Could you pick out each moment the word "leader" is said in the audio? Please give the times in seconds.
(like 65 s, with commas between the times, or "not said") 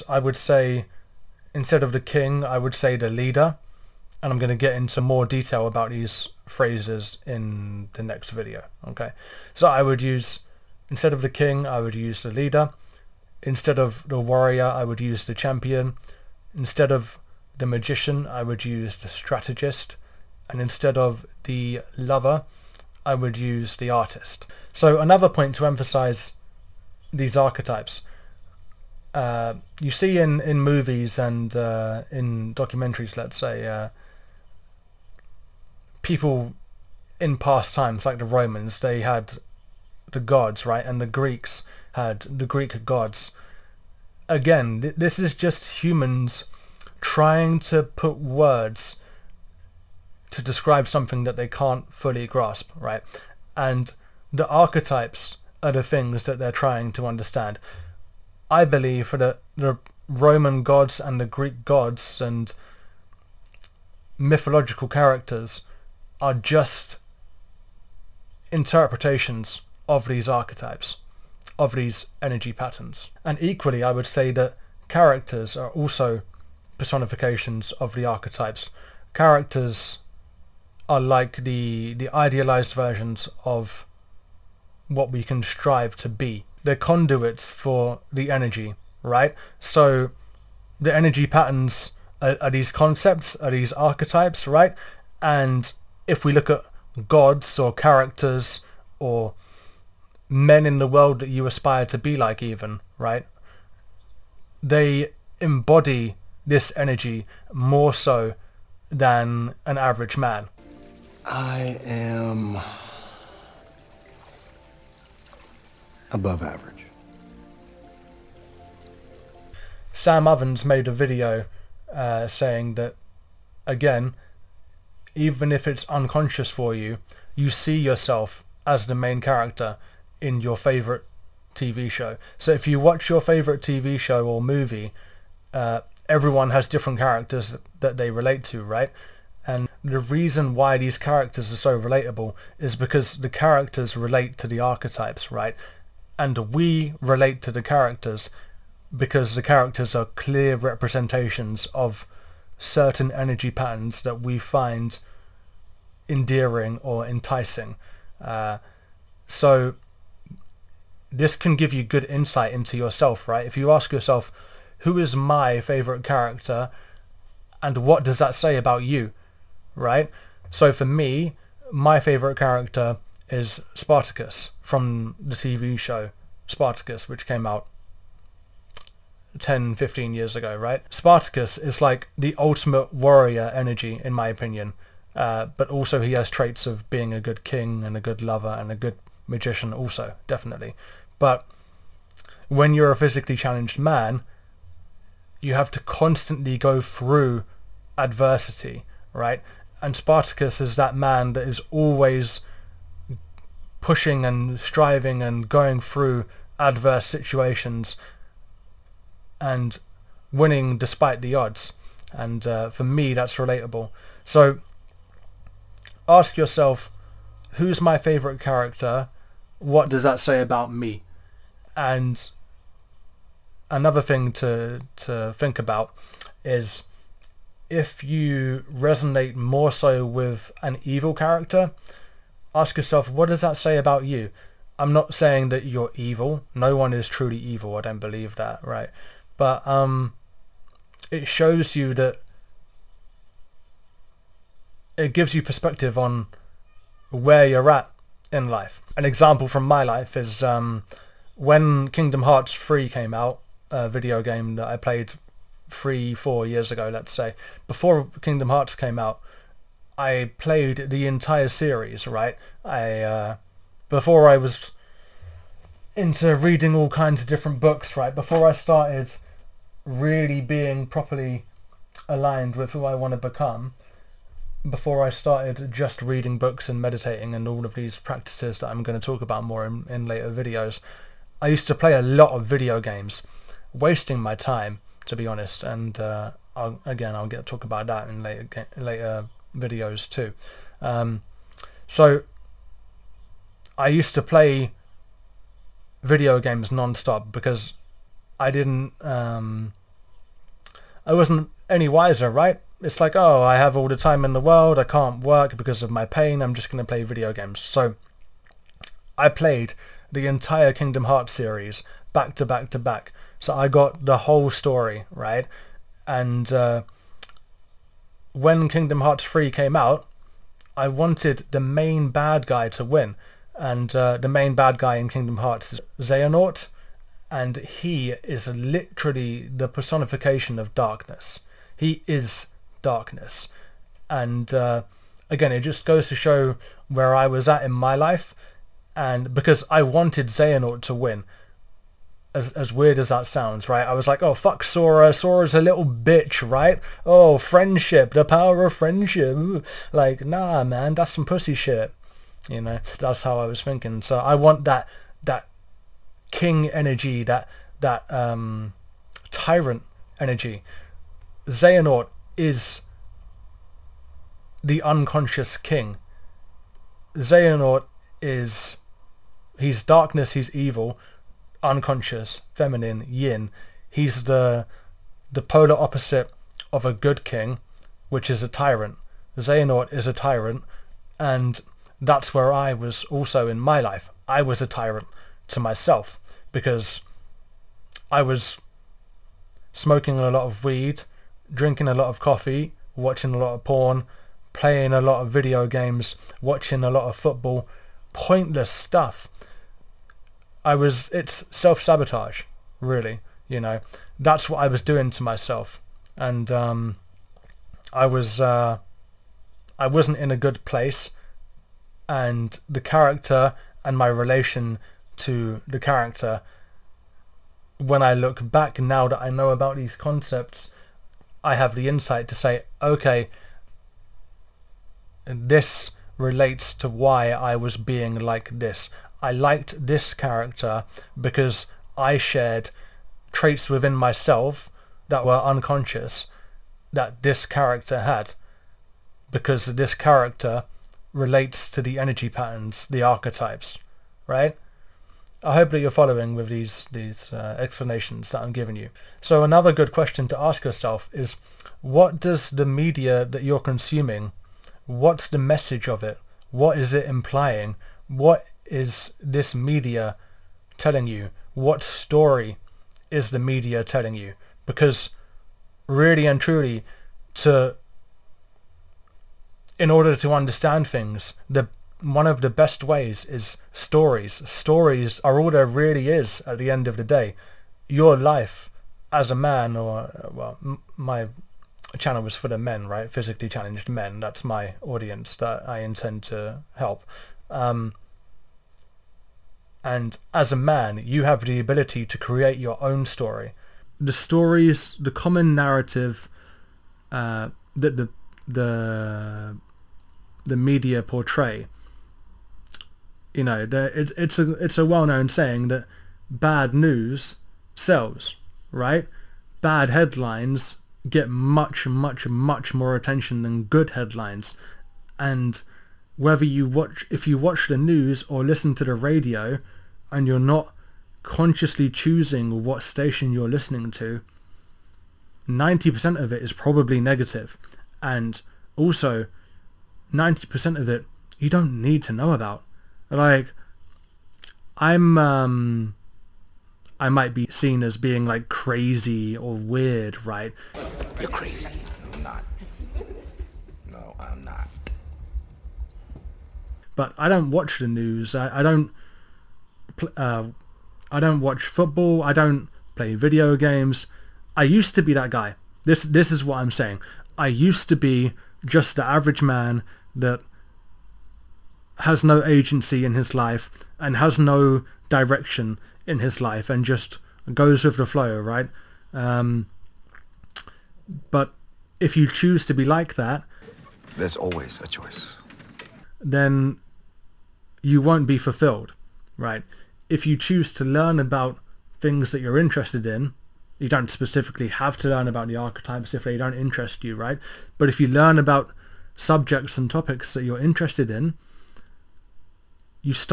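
3 s, 12 s.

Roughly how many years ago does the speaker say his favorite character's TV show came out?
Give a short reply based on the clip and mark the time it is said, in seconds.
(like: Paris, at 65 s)
10 to 15 years, at 179 s.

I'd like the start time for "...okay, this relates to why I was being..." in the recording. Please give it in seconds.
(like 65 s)
422 s.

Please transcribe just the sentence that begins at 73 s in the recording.
And equally, I would say that characters are also personifications of the archetypes.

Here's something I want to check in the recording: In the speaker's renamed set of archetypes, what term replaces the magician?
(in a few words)
the strategist.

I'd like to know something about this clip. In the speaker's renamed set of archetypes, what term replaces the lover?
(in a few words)
the artist.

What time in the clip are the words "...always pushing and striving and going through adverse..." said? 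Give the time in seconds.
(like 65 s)
201 s.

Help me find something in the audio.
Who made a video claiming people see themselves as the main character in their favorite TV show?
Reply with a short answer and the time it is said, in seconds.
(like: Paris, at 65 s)
Sam Ovens, at 119 s.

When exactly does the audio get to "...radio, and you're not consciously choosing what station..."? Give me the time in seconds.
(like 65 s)
518 s.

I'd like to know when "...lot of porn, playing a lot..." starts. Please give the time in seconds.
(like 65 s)
393 s.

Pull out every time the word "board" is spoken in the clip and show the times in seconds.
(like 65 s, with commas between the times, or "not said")
not said.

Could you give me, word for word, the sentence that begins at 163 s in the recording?
If you ask yourself, who is my favorite character and what does that say about you, right?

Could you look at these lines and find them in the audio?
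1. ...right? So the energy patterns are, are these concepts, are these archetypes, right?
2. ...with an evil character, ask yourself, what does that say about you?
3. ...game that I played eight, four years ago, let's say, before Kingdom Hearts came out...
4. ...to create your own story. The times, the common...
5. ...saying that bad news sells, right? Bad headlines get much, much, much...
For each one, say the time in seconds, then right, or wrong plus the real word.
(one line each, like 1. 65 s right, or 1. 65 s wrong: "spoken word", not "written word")
1. 89 s right
2. 230 s right
3. 254 s wrong: "three", not "eight"
4. 492 s wrong: "stories", not "times"
5. 505 s right.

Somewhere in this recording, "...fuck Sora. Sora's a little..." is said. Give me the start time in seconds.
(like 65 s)
344 s.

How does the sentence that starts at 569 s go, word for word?
Um, but if you choose to be like that, there's always a choice.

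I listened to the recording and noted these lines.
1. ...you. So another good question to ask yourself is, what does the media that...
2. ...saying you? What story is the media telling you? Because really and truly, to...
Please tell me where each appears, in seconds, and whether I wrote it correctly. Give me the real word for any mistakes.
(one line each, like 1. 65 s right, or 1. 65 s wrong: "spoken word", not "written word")
1. 448 s right
2. 460 s wrong: "telling", not "saying".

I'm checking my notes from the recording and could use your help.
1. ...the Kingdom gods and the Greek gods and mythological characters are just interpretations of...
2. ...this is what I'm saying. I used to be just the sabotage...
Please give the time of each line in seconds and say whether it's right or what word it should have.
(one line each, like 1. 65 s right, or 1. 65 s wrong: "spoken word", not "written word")
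1. 59 s wrong: "Roman", not "Kingdom"
2. 556 s wrong: "average", not "sabotage".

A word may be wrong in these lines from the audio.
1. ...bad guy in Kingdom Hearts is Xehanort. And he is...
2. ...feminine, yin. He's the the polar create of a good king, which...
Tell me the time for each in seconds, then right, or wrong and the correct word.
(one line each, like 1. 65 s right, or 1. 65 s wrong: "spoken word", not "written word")
1. 324 s right
2. 372 s wrong: "opposite", not "create".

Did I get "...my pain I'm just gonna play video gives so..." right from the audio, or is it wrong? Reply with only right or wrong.
wrong.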